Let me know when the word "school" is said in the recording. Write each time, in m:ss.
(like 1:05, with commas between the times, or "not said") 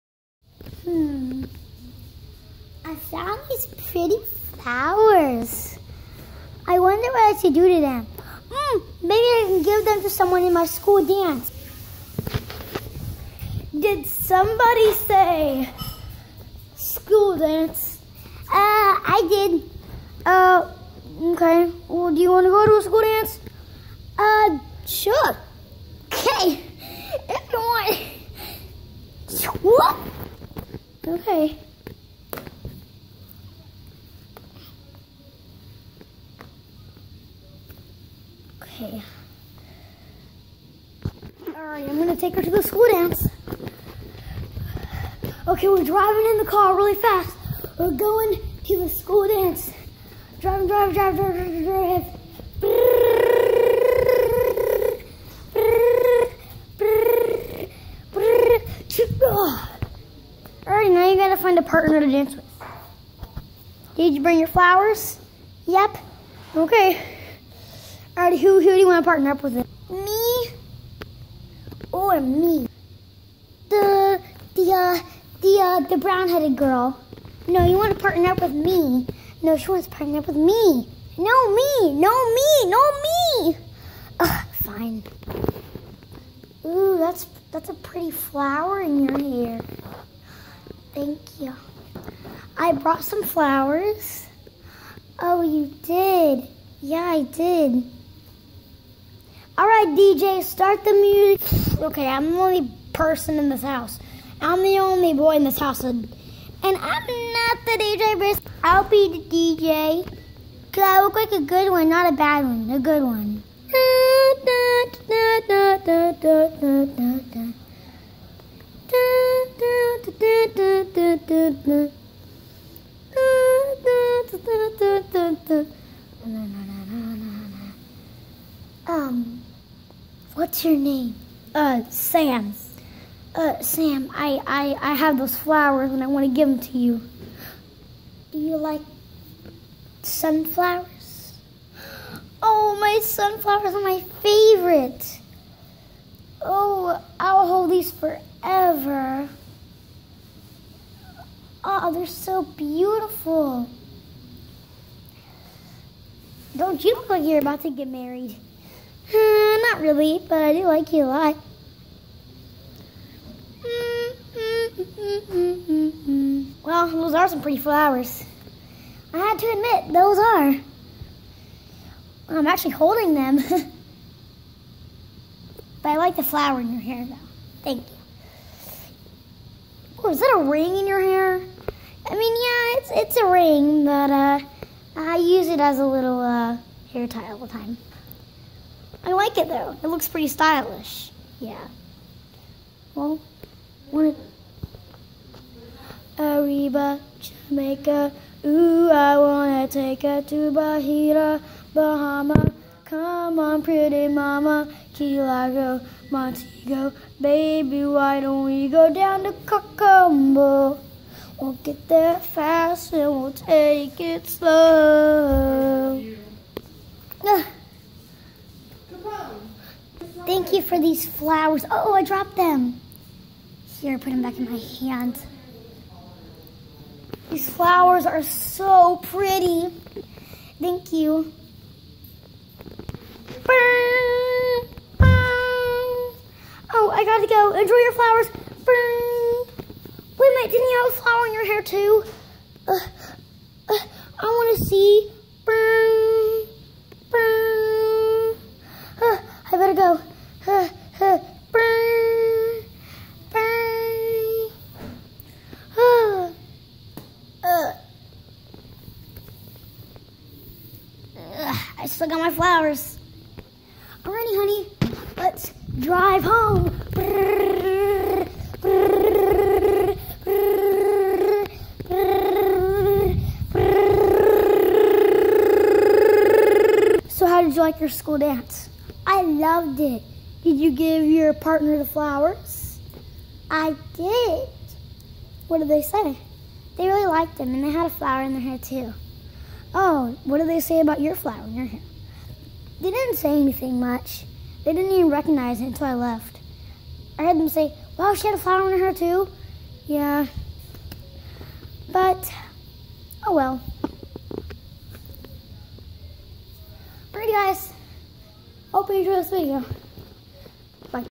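0:10, 0:16, 0:22, 0:42, 0:48, 4:37.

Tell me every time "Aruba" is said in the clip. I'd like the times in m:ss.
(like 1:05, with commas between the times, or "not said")
3:16.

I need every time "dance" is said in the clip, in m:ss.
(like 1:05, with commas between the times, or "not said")
0:11, 0:17, 0:23, 0:42, 0:49, 1:02, 4:38.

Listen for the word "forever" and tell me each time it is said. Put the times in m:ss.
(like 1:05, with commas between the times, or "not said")
2:27.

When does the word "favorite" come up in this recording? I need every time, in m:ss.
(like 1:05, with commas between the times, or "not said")
2:24.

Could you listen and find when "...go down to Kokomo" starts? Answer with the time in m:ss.
3:28.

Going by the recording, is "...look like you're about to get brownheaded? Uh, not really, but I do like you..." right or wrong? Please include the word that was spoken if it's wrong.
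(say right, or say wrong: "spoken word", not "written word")
wrong: "married", not "brownheaded".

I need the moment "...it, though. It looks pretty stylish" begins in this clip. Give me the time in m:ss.
3:09.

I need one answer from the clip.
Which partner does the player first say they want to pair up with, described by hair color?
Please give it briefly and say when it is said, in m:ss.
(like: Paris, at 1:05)
The brown-headed girl, at 1:15.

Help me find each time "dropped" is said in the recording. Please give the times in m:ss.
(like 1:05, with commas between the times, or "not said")
3:42.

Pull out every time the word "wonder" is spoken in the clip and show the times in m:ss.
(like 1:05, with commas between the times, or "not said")
0:06.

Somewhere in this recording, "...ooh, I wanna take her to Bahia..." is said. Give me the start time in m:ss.
3:18.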